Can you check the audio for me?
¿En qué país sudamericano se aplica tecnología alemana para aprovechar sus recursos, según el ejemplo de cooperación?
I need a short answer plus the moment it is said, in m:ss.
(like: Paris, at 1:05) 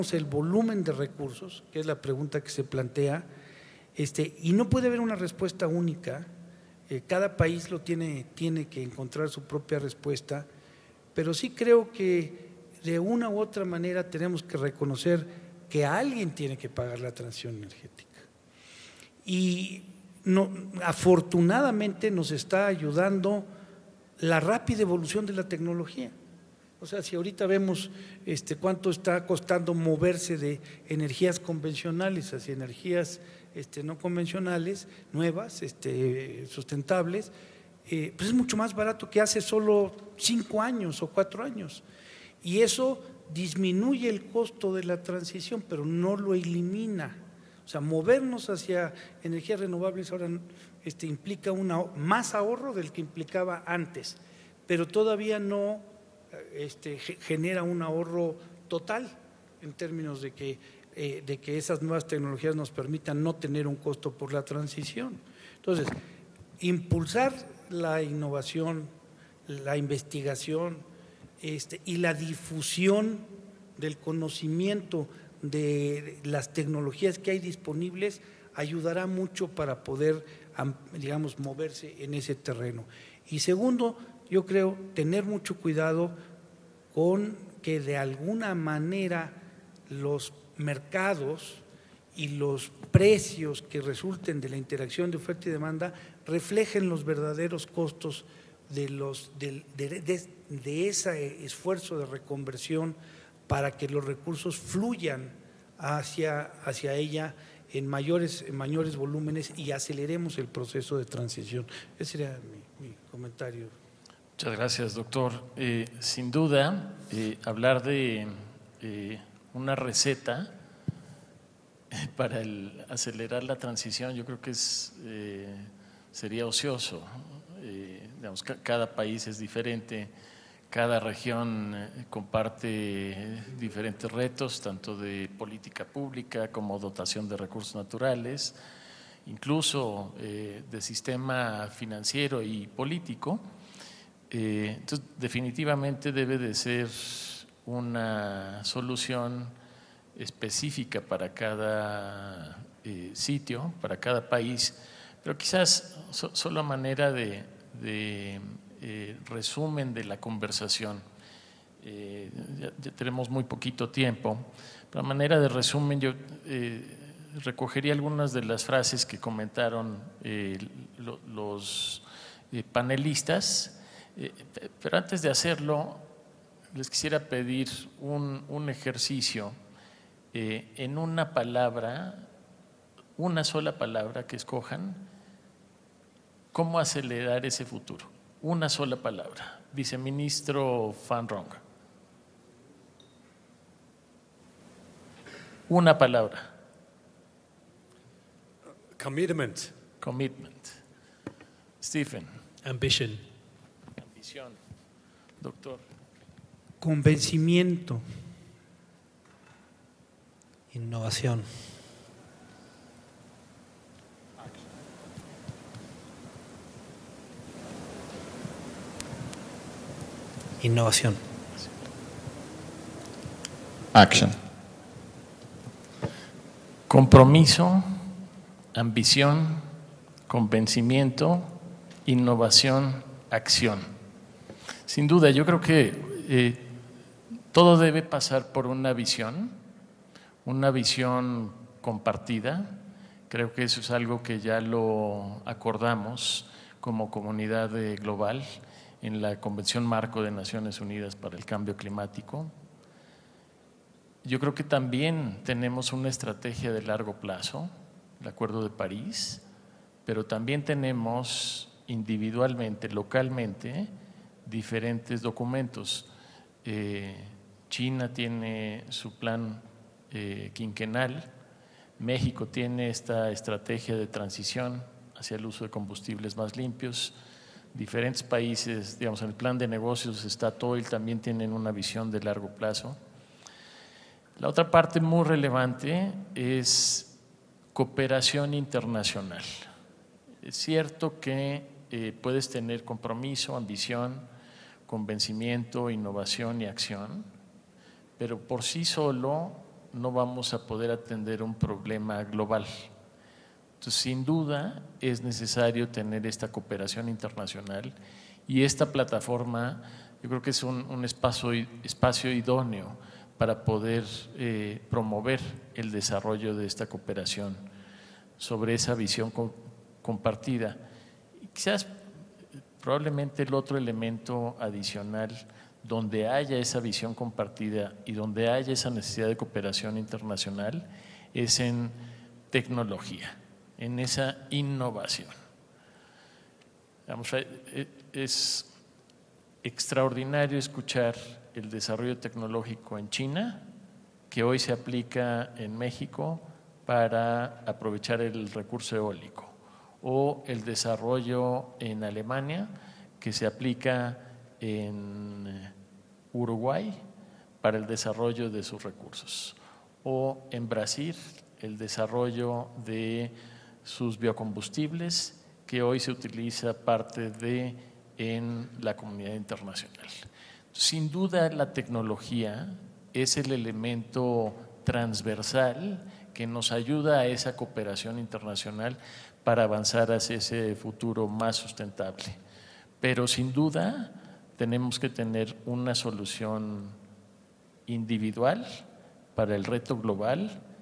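Uruguay, at 5:56.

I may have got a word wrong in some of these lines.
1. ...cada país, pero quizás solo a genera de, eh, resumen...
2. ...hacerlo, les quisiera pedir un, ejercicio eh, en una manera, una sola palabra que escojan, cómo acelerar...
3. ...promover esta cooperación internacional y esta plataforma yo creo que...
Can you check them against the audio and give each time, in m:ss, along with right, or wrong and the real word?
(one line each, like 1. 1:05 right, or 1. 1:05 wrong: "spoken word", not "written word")
1. 2:33 wrong: "manera", not "genera"
2. 2:55 wrong: "palabra", not "manera"
3. 5:05 wrong: "tener", not "promover".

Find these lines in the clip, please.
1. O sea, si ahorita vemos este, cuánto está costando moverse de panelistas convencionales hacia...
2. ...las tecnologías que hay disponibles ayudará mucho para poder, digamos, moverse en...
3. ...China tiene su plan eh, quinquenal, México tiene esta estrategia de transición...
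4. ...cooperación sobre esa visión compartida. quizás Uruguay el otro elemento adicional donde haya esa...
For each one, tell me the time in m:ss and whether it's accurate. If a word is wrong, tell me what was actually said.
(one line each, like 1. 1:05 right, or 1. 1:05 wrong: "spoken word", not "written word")
1. 0:26 wrong: "energías", not "panelistas"
2. 1:16 right
3. 4:27 right
4. 5:16 wrong: "Probablemente", not "Uruguay".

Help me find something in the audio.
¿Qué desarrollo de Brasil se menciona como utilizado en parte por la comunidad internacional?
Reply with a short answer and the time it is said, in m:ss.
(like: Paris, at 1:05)
Biocombustibles, at 6:04.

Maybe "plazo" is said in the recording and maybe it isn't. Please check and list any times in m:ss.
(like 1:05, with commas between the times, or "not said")
4:17, 4:42.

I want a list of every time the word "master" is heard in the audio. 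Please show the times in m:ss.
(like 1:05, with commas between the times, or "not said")
not said.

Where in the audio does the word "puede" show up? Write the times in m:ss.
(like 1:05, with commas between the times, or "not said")
0:04, 4:52.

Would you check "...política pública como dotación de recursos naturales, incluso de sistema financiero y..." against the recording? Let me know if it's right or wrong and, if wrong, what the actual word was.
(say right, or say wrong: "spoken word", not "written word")
right.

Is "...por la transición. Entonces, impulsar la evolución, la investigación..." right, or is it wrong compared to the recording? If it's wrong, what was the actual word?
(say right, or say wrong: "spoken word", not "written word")
wrong: "innovación", not "evolución".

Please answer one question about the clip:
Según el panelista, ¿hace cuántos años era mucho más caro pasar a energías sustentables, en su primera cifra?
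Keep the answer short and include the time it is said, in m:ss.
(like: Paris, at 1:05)
5, at 0:40.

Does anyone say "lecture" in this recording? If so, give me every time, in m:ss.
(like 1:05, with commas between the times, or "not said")
not said.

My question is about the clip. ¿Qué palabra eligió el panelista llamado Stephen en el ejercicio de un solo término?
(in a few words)
Ambition.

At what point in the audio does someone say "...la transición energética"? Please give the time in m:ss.
0:16.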